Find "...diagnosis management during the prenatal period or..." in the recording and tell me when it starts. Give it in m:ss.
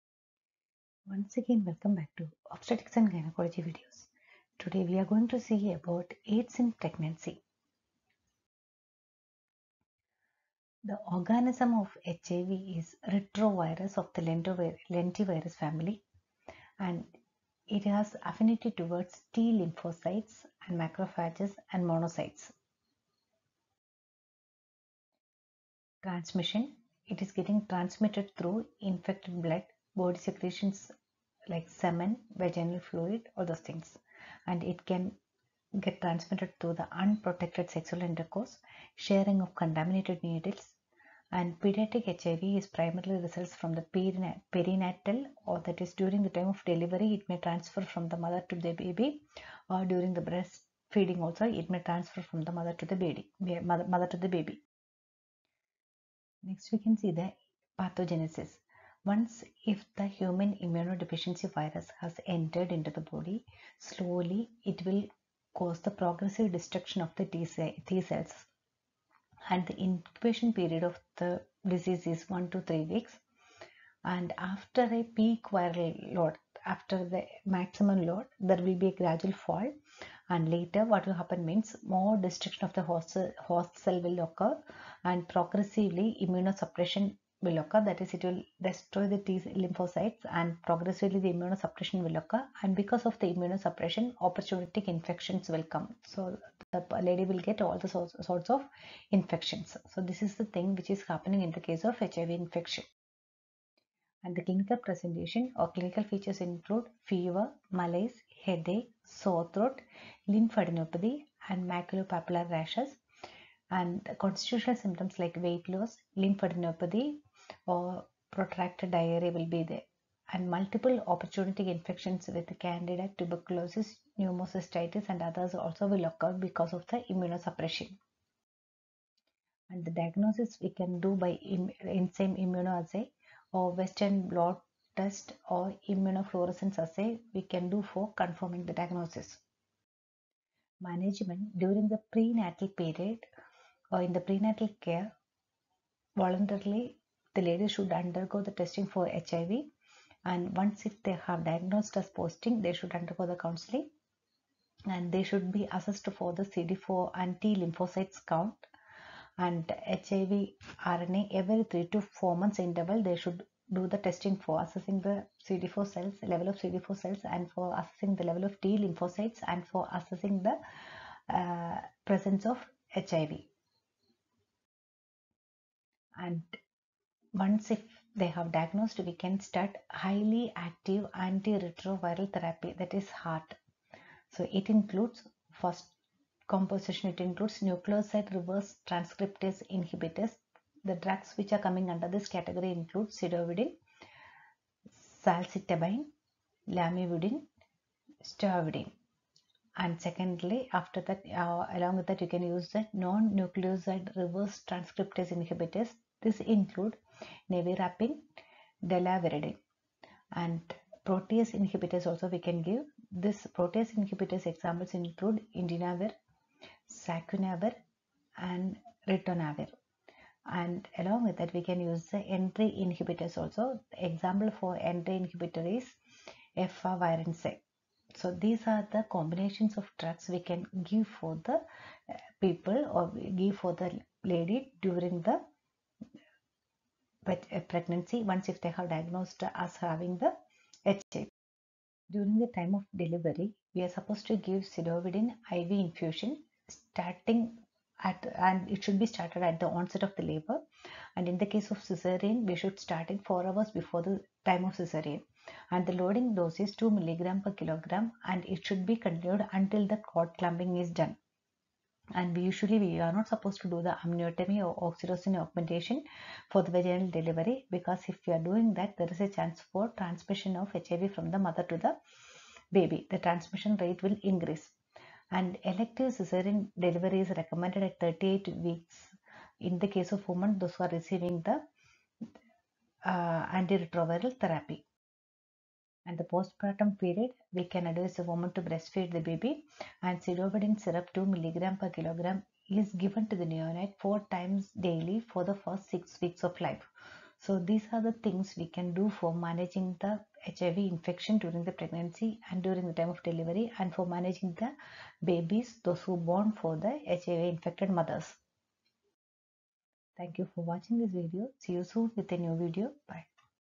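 2:18.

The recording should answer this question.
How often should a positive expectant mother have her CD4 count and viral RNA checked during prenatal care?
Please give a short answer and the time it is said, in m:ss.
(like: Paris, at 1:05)
every 3 to 4 months, at 2:41.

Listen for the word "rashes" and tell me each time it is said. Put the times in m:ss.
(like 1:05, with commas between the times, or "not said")
1:52.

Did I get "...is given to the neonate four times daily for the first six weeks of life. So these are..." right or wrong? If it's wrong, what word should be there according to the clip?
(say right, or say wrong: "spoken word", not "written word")
right.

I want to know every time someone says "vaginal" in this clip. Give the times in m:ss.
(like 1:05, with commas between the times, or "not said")
0:32, 4:26.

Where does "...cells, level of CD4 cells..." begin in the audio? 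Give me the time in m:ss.
2:45.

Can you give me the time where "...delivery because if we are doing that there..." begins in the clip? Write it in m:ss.
4:27.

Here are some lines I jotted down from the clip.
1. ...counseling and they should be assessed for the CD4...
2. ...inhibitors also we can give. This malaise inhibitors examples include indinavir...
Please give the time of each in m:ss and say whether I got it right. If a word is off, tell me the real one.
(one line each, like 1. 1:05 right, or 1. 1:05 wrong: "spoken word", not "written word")
1. 2:33 right
2. 3:31 wrong: "protease", not "malaise".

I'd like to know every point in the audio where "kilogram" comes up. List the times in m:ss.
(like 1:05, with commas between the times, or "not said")
4:17, 4:51.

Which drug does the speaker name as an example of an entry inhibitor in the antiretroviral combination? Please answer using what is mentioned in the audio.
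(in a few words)
efavirenz.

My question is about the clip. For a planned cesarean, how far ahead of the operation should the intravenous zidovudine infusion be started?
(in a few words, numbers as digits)
4 hours.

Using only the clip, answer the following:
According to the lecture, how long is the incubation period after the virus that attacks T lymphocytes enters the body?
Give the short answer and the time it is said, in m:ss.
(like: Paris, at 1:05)
1 to 3 weeks, at 1:12.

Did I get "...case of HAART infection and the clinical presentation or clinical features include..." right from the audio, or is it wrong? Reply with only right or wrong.
wrong.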